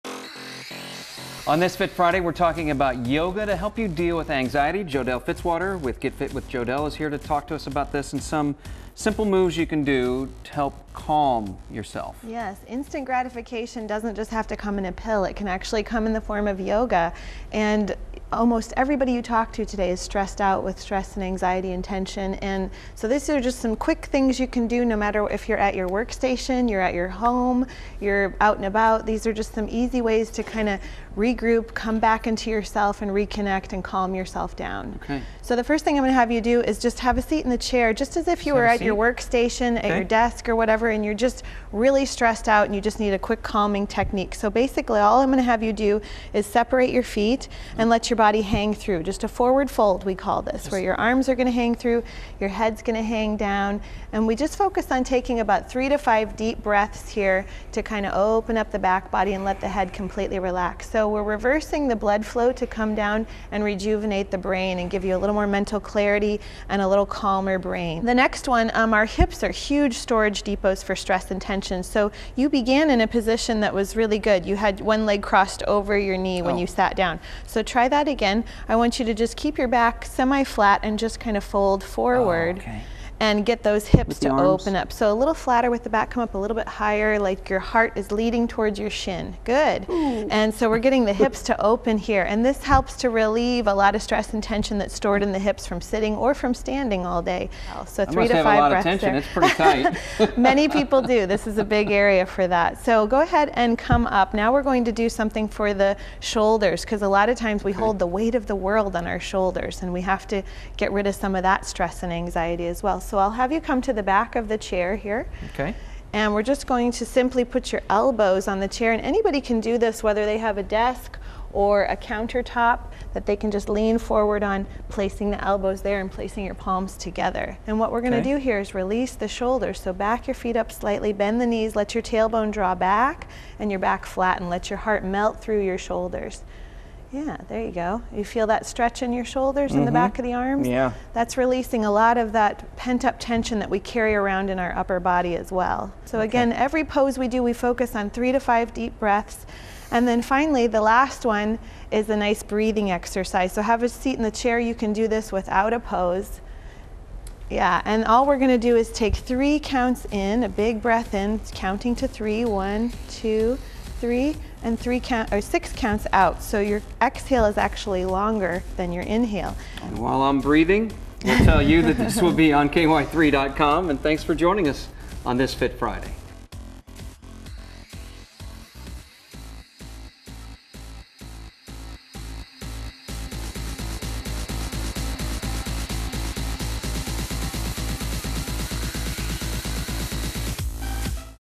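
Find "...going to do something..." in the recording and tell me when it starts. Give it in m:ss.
1:44.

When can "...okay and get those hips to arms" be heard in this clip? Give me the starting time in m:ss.
1:22.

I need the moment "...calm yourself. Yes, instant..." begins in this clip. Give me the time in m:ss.
0:10.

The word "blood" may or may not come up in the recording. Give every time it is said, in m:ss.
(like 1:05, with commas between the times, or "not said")
1:01.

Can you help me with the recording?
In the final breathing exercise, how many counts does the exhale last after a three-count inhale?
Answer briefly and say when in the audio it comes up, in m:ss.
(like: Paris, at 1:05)
6, at 2:45.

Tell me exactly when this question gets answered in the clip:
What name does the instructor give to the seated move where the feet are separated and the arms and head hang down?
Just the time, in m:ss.
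0:49.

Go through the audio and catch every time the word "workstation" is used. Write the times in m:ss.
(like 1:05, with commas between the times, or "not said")
0:25, 0:38.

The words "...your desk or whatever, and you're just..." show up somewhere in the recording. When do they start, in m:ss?
0:39.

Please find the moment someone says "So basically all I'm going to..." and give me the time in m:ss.
0:44.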